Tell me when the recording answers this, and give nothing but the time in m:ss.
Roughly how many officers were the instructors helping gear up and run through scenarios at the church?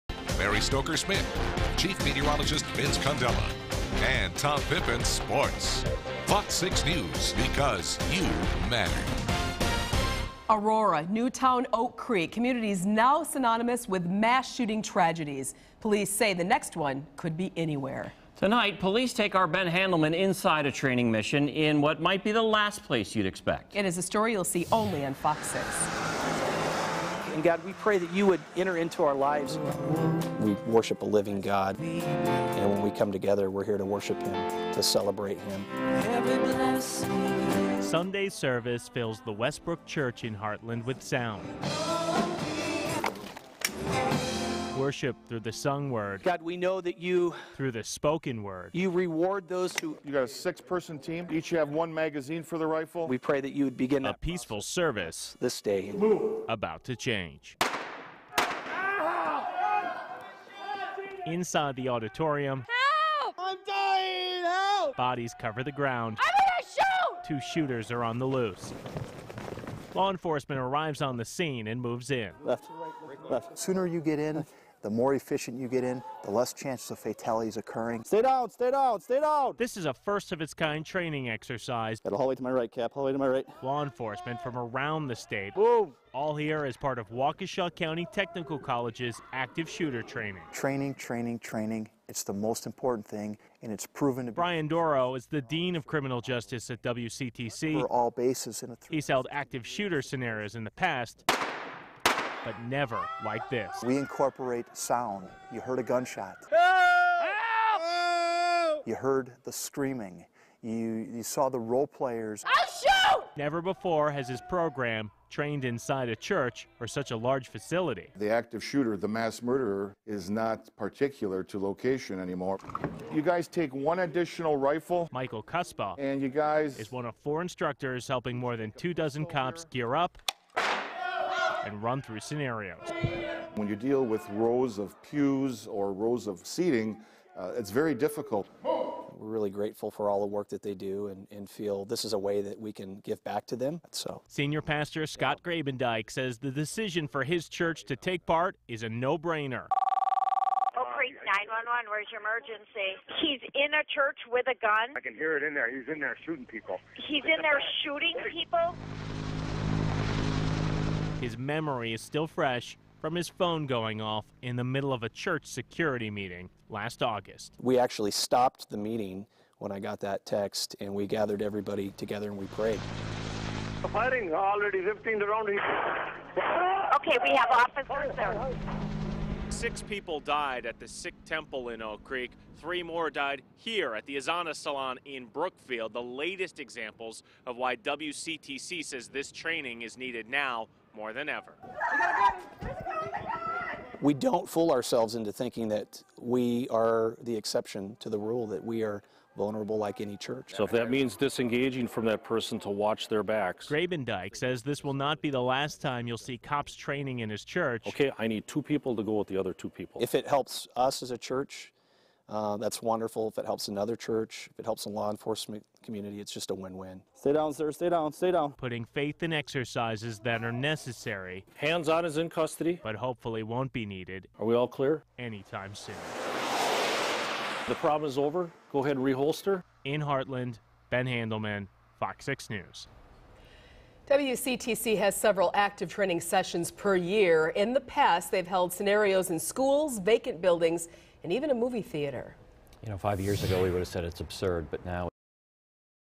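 2:08.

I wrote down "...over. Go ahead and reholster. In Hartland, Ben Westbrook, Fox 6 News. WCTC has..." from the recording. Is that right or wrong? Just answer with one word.
wrong.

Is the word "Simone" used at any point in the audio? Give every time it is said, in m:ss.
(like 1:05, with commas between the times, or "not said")
not said.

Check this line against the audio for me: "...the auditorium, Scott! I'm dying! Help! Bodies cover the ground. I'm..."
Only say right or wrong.
wrong.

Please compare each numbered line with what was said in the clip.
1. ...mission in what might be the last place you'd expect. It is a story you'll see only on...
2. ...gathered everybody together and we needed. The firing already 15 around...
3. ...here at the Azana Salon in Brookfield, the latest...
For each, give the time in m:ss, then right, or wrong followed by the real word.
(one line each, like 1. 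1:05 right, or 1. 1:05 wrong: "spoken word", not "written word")
1. 0:21 right
2. 2:51 wrong: "prayed", not "needed"
3. 3:03 right.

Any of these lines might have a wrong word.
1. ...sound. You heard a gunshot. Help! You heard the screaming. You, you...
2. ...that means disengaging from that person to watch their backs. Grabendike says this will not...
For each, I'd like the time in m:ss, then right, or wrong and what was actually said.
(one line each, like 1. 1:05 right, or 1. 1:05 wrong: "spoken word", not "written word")
1. 1:44 right
2. 3:20 right.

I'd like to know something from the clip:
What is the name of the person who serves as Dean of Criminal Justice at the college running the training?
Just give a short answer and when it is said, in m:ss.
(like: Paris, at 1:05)
Brian Doro, at 1:34.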